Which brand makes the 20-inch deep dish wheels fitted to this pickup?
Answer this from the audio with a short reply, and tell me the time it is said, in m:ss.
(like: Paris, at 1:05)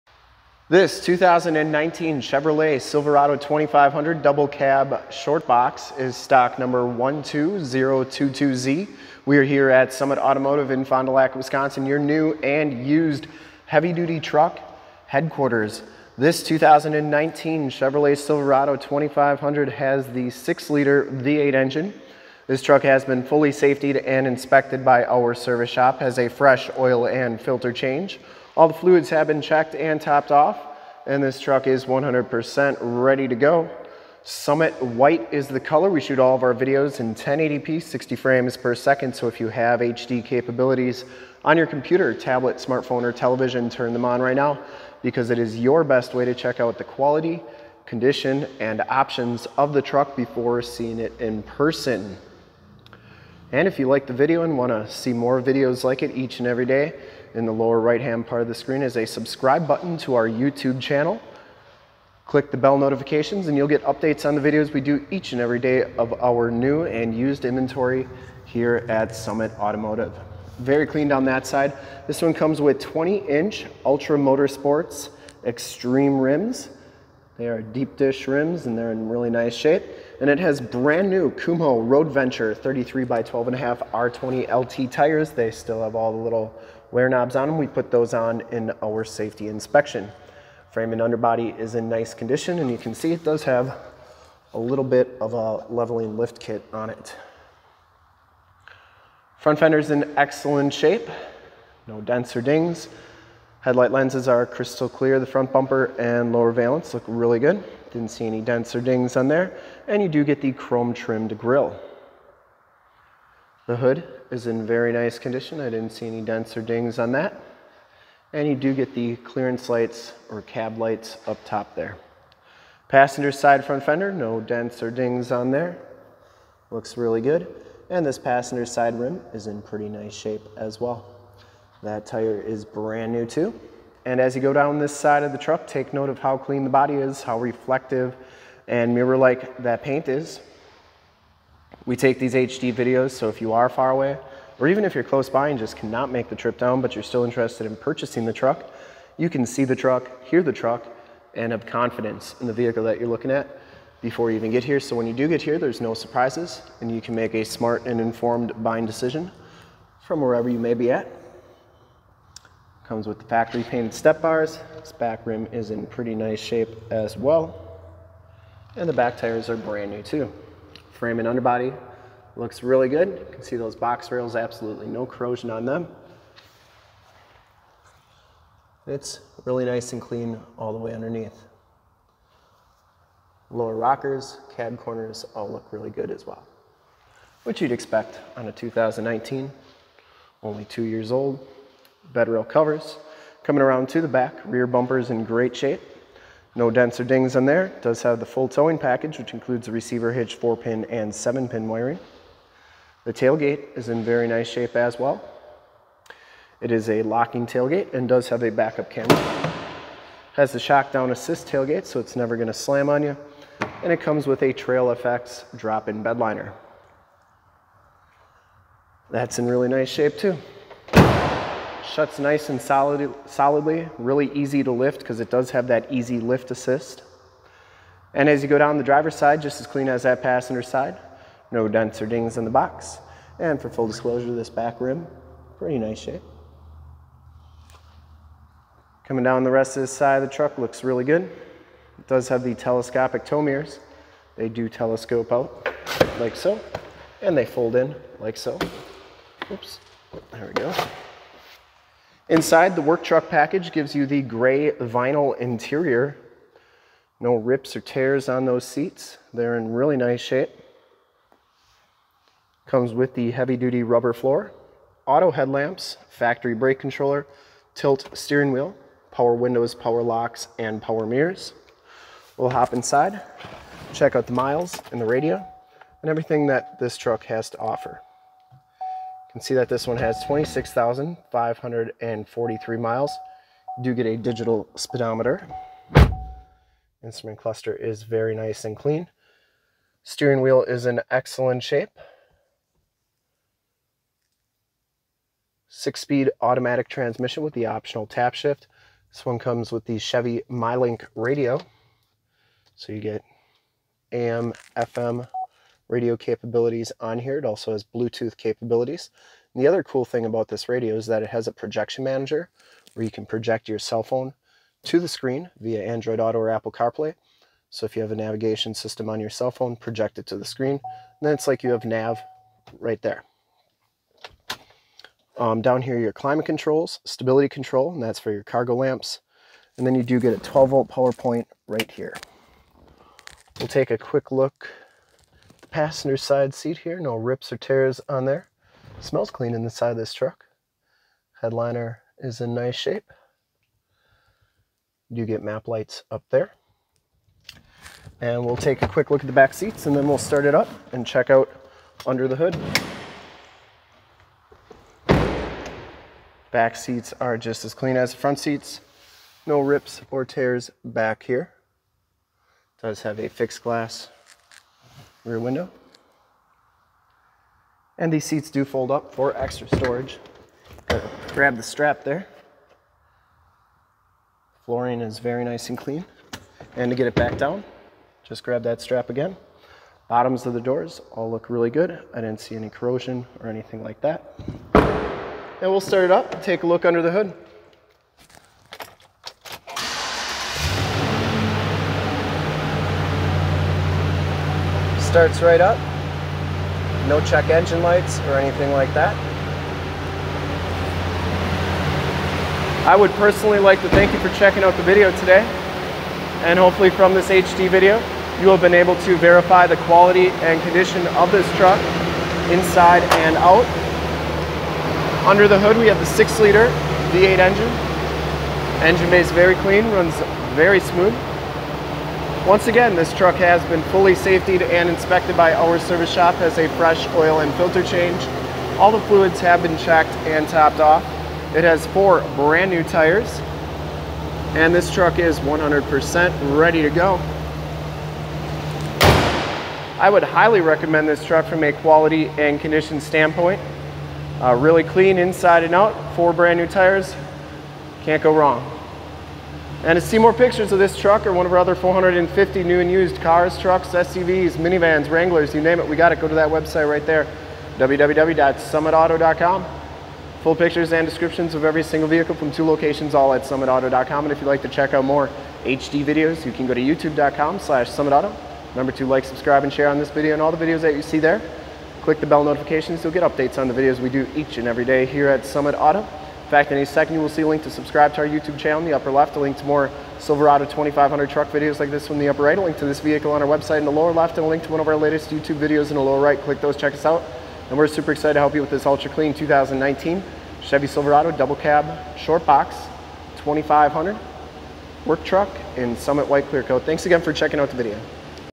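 Ultra Motorsports Extreme, at 1:13.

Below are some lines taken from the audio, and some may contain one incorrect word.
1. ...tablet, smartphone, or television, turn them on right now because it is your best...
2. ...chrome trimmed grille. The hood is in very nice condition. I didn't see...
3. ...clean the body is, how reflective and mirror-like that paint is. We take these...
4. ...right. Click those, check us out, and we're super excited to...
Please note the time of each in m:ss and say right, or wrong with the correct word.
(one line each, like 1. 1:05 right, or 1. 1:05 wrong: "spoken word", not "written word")
1. 0:42 right
2. 1:50 right
3. 2:16 right
4. 8:06 right.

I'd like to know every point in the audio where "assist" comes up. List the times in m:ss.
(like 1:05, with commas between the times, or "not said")
3:31, 3:46.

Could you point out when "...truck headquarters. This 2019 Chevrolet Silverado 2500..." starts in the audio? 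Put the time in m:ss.
0:14.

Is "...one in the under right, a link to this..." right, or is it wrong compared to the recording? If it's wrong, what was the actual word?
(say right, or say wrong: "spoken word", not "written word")
wrong: "upper", not "under".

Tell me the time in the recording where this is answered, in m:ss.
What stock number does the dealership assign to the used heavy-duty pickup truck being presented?
0:06.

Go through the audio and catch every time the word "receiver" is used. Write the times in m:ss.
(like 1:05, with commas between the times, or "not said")
3:19.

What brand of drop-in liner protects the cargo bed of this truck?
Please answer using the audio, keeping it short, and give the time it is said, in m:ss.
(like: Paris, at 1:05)
Trail FX, at 3:34.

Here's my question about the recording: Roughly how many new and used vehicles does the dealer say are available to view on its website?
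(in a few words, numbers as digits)
450.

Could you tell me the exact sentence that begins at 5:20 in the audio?
And then it's like you have nav right there.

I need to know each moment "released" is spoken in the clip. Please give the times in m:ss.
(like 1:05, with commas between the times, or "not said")
not said.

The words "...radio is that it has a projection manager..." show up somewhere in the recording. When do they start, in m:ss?
5:10.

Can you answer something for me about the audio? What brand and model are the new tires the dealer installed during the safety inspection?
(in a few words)
Kumho Road Venture.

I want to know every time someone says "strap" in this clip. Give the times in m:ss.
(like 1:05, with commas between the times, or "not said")
6:11, 6:18.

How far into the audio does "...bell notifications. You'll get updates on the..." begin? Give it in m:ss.
7:52.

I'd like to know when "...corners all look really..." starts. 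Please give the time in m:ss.
3:04.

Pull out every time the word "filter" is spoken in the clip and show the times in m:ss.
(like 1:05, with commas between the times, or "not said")
0:27, 7:07.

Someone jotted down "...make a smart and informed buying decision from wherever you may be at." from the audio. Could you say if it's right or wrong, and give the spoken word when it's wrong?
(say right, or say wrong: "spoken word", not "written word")
right.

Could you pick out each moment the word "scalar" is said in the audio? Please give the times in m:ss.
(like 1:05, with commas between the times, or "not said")
not said.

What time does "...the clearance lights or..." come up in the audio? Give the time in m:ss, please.
1:58.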